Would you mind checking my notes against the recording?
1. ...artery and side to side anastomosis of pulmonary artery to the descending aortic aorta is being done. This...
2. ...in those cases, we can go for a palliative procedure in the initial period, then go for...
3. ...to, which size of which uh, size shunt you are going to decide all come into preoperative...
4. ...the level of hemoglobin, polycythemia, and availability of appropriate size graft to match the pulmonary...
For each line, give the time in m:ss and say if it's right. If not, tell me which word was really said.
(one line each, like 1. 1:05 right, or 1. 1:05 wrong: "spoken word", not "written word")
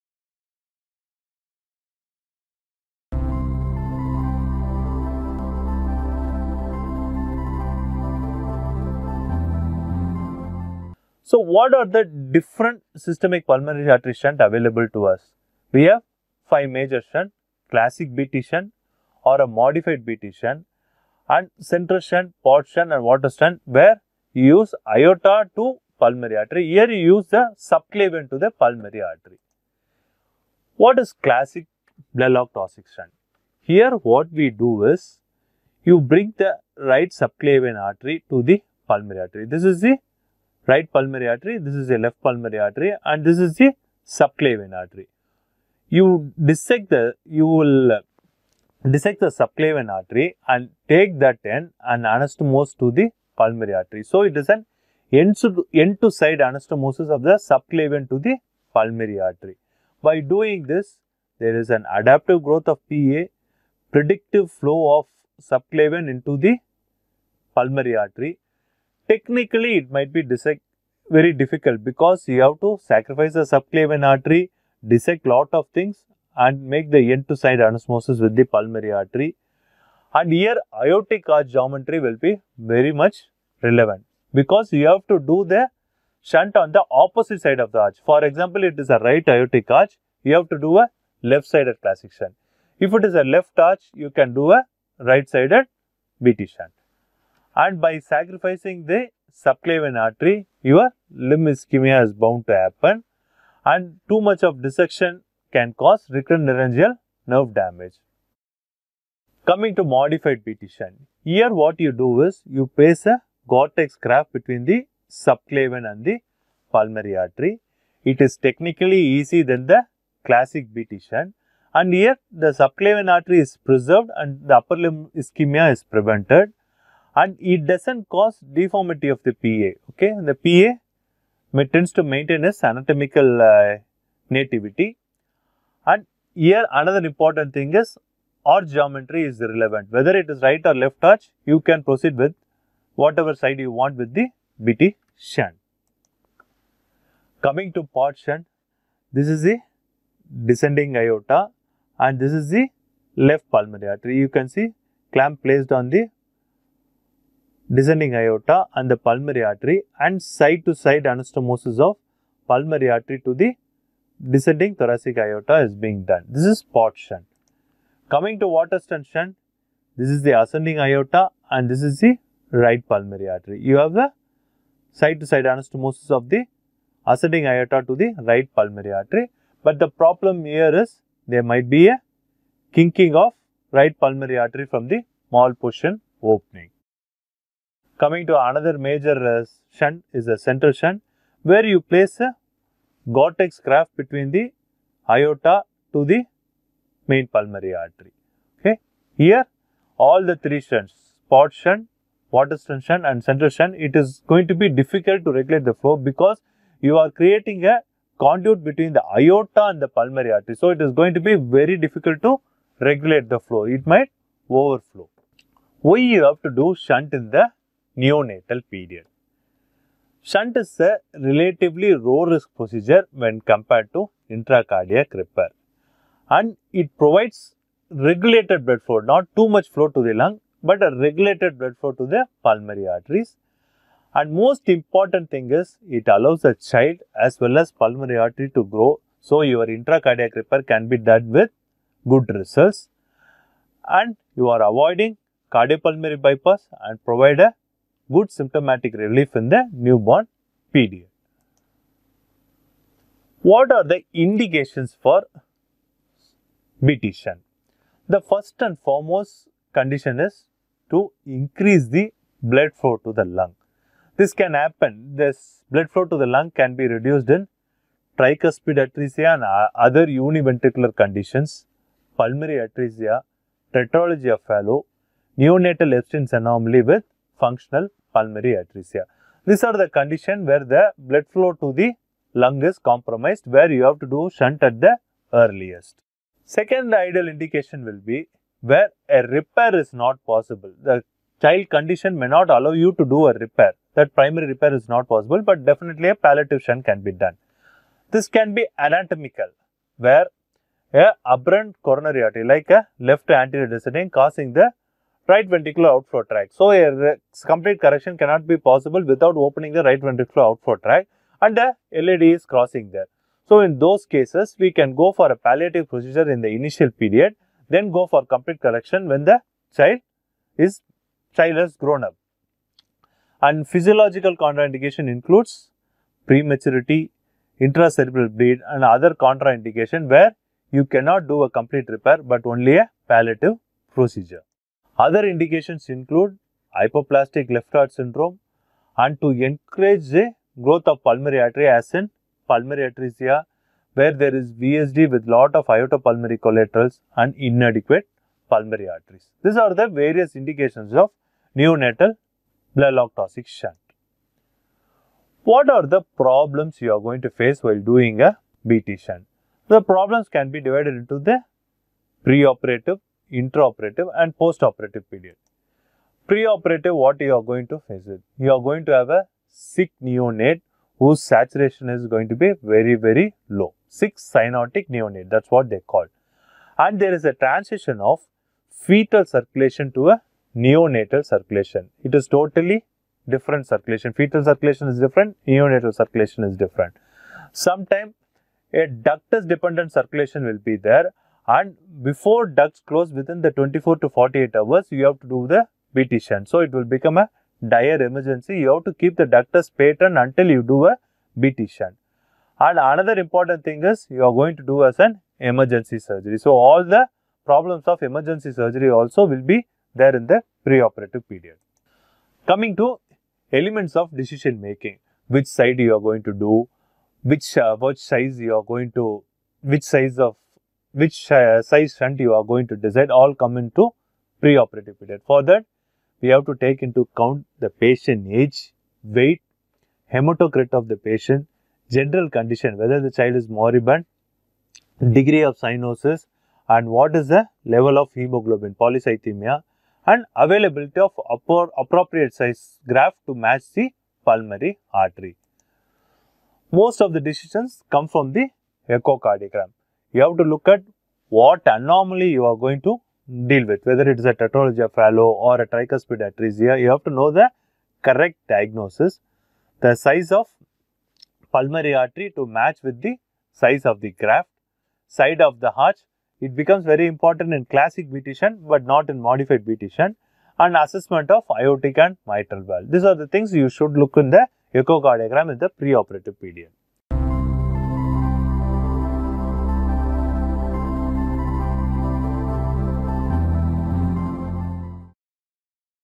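1. 2:39 wrong: "thoracic", not "aortic"
2. 5:13 right
3. 6:59 right
4. 7:17 right.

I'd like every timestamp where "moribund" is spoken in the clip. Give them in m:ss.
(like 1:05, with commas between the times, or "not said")
7:13.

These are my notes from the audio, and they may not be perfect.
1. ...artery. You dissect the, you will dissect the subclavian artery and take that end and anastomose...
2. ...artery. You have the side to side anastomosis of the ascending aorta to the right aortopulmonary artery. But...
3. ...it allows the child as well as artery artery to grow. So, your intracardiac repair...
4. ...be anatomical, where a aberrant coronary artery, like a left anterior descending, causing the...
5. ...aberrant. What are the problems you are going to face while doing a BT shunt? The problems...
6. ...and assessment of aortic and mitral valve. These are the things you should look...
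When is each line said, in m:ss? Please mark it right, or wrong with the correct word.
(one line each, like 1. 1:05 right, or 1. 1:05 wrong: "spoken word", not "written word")
1. 0:44 right
2. 2:53 wrong: "pulmonary", not "aortopulmonary"
3. 3:55 wrong: "pulmonary", not "artery"
4. 4:58 right
5. 5:53 wrong: "shunt", not "aberrant"
6. 7:50 right.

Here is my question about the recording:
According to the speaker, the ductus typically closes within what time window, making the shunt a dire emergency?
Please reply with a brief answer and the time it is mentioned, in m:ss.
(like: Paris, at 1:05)
24 to 48 hours, at 6:33.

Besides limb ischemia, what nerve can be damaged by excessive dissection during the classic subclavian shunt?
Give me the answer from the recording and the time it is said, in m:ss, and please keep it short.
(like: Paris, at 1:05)
recurrent laryngeal nerve, at 1:46.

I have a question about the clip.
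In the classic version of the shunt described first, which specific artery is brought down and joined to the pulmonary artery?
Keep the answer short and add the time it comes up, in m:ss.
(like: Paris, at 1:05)
right subclavian artery, at 0:36.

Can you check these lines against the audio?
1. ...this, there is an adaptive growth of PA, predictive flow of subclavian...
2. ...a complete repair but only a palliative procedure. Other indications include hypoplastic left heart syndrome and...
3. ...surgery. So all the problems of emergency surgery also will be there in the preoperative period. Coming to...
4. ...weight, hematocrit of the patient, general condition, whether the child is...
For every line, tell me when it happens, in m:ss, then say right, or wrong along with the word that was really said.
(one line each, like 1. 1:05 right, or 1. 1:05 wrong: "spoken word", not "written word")
1. 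1:00 right
2. 5:31 right
3. 6:45 right
4. 7:09 right.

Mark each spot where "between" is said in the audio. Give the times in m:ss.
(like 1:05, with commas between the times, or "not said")
1:54, 3:13, 3:28.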